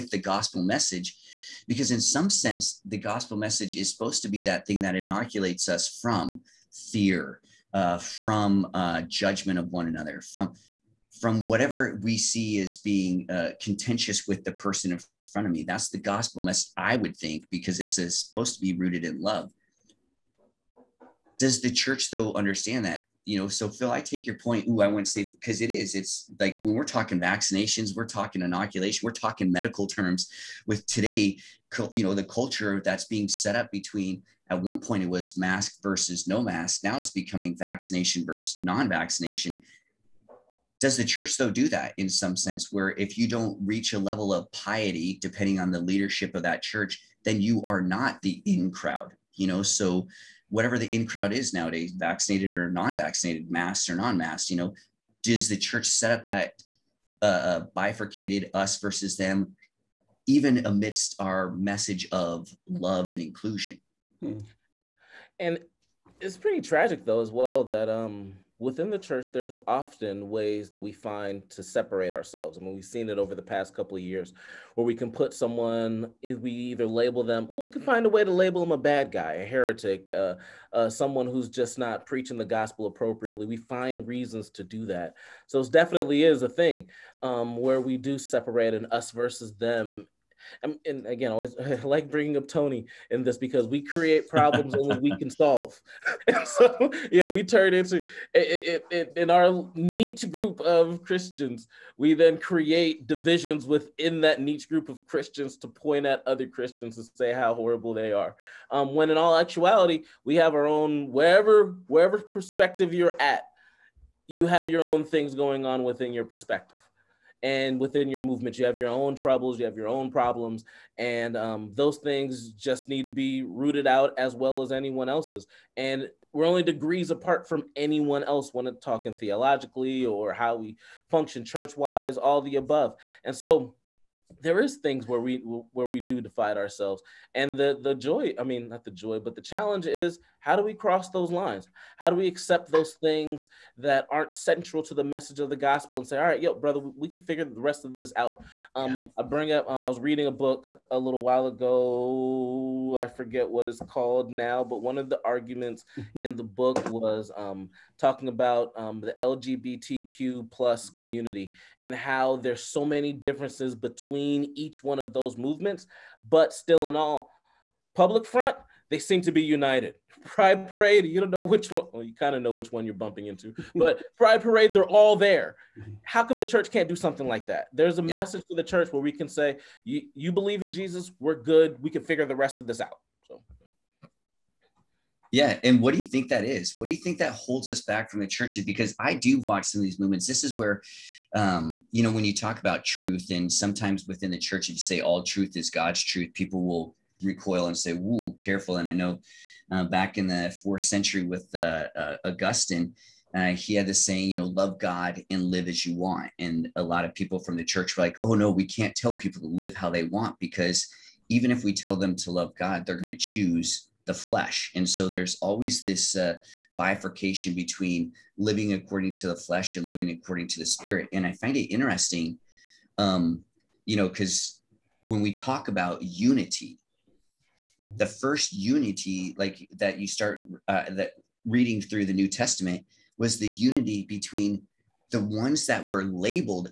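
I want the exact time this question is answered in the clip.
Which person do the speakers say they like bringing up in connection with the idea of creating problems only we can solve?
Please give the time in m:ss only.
1:32.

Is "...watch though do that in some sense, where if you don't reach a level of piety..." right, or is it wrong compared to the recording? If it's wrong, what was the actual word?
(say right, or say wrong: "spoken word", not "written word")
wrong: "church", not "watch".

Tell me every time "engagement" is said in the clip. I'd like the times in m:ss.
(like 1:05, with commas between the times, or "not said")
not said.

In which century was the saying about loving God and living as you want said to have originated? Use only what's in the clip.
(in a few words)
4th century.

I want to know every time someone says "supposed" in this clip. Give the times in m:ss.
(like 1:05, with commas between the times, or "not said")
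0:03, 0:18.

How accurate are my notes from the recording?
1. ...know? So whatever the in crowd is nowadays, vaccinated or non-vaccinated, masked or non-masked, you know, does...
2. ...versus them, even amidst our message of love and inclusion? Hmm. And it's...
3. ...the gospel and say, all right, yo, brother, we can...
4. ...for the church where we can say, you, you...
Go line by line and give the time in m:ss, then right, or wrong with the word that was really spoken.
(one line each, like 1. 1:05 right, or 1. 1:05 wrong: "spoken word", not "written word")
1. 0:49 right
2. 0:58 right
3. 2:25 right
4. 2:58 right.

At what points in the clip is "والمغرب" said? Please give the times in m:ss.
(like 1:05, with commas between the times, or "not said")
not said.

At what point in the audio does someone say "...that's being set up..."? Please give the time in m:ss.
0:32.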